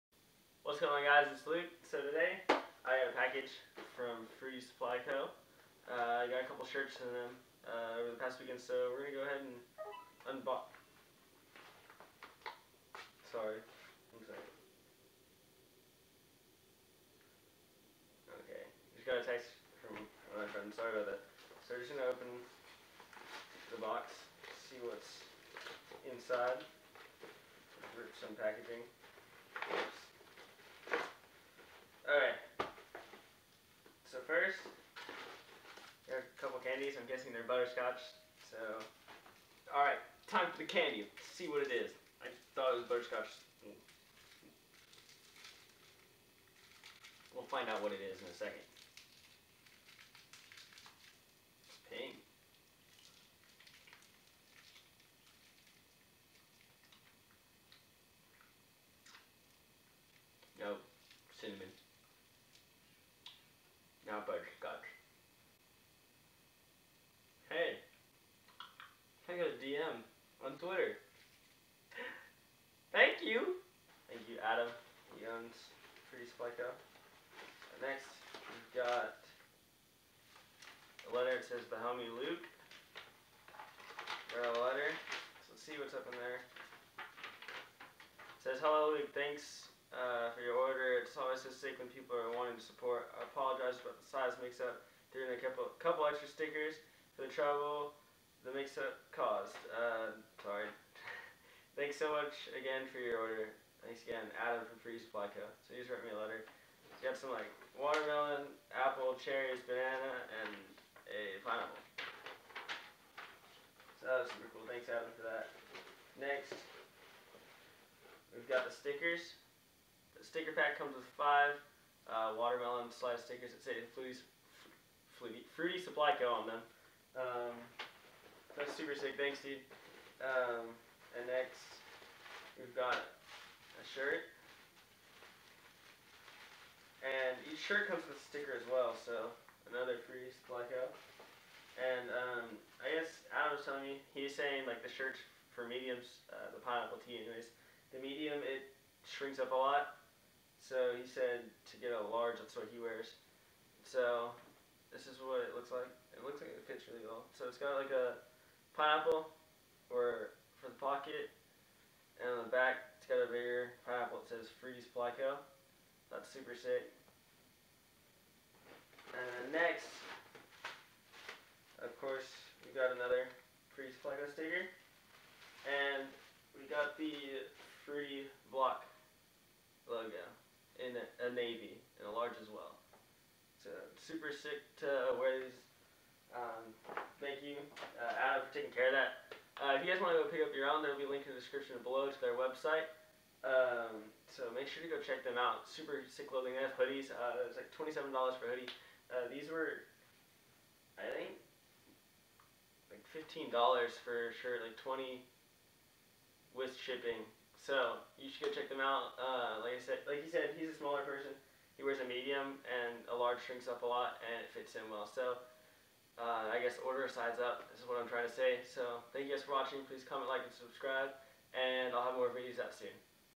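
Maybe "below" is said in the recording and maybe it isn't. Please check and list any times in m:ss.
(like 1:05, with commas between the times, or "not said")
3:11.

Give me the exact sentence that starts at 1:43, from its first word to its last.
Thanks again, Adam from Fruity Supply Co.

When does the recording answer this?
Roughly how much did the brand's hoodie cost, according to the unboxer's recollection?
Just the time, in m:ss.
3:17.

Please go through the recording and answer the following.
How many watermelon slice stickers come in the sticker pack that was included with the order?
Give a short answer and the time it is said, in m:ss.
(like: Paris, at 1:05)
5, at 2:01.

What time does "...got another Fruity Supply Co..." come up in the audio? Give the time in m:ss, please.
2:52.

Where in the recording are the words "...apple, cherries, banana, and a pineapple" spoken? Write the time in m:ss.
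1:48.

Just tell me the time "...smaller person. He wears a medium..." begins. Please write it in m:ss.
3:30.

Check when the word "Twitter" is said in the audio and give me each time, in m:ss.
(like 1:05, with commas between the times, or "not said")
1:10.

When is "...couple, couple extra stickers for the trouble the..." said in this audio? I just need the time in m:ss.
1:35.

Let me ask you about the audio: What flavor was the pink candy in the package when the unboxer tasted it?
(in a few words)
Cinnamon.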